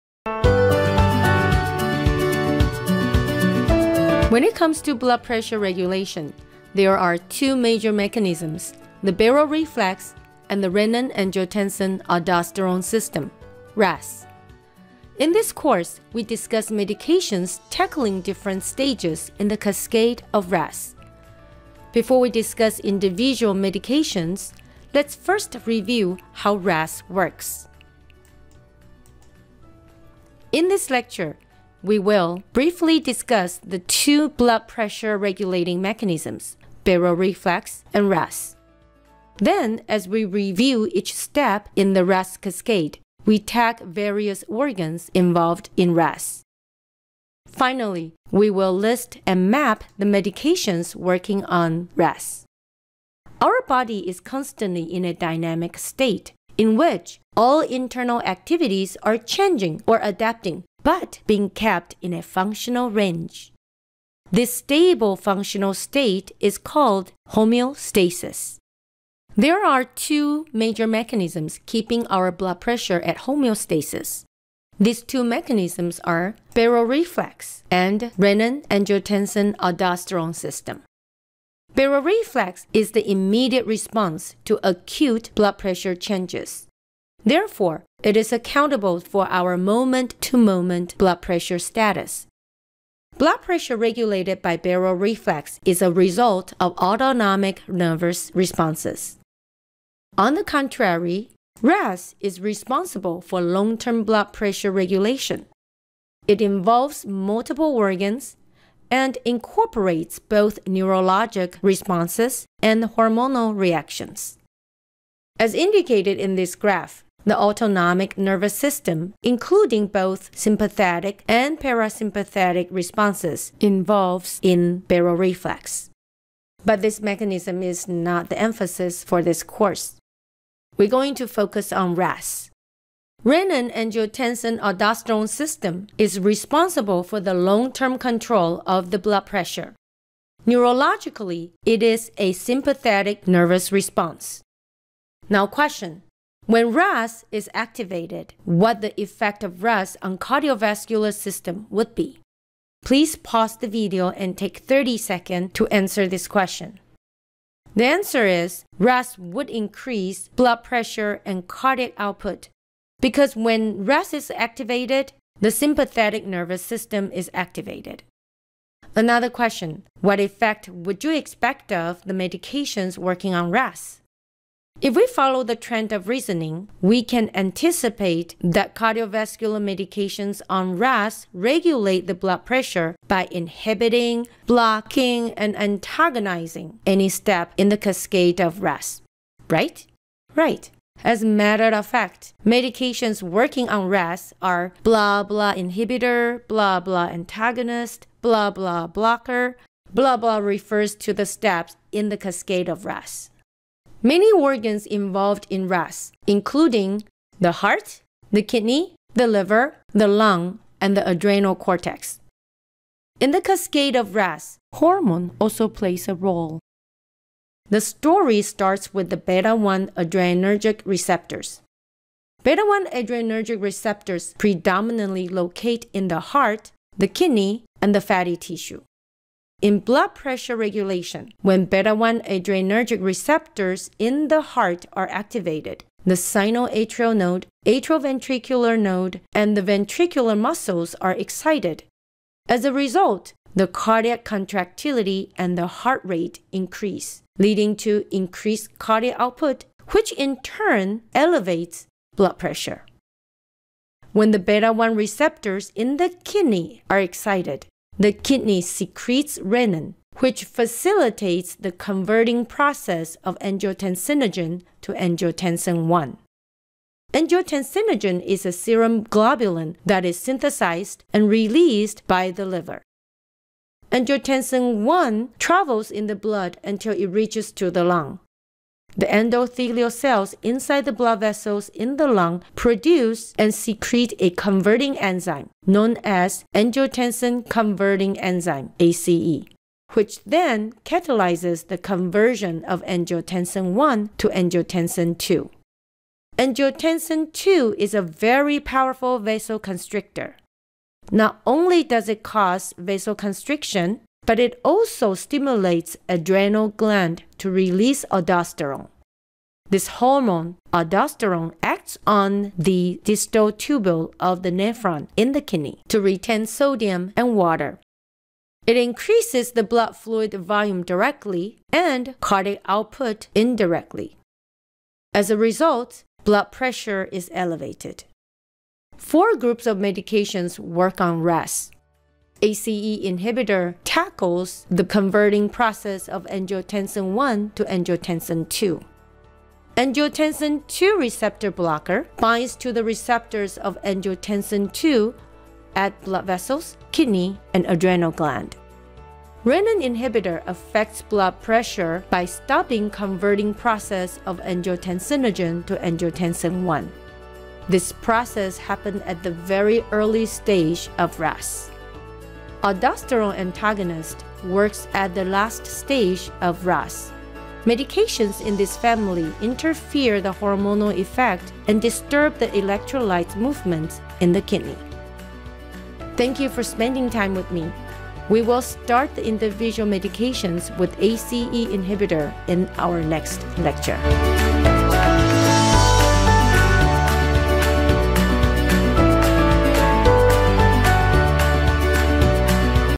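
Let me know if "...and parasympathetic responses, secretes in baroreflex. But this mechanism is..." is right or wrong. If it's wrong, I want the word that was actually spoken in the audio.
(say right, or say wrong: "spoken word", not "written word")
wrong: "involves", not "secretes".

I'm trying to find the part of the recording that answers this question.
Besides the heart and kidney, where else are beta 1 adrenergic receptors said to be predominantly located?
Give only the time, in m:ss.
3:47.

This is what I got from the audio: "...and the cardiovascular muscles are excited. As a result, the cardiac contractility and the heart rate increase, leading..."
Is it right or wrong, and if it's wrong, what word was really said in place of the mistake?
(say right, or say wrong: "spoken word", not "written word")
wrong: "ventricular", not "cardiovascular".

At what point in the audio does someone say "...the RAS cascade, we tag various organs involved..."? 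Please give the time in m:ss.
0:41.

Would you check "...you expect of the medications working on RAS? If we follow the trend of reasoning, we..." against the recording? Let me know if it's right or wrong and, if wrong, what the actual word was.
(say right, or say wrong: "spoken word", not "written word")
right.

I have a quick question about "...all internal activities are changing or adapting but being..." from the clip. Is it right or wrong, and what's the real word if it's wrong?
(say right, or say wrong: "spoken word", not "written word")
right.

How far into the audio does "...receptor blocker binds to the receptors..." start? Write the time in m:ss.
5:40.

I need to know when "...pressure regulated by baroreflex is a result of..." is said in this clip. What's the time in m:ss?
1:33.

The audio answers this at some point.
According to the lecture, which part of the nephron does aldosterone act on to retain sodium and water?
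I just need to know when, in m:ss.
5:13.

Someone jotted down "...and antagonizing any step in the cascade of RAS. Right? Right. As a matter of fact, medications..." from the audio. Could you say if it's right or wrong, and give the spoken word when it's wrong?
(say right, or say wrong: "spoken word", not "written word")
right.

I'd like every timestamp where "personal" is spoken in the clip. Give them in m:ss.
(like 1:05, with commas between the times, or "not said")
not said.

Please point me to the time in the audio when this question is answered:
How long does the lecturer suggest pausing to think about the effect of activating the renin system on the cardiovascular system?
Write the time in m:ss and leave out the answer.
2:34.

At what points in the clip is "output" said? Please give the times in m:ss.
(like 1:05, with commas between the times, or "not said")
2:41, 4:09, 5:22.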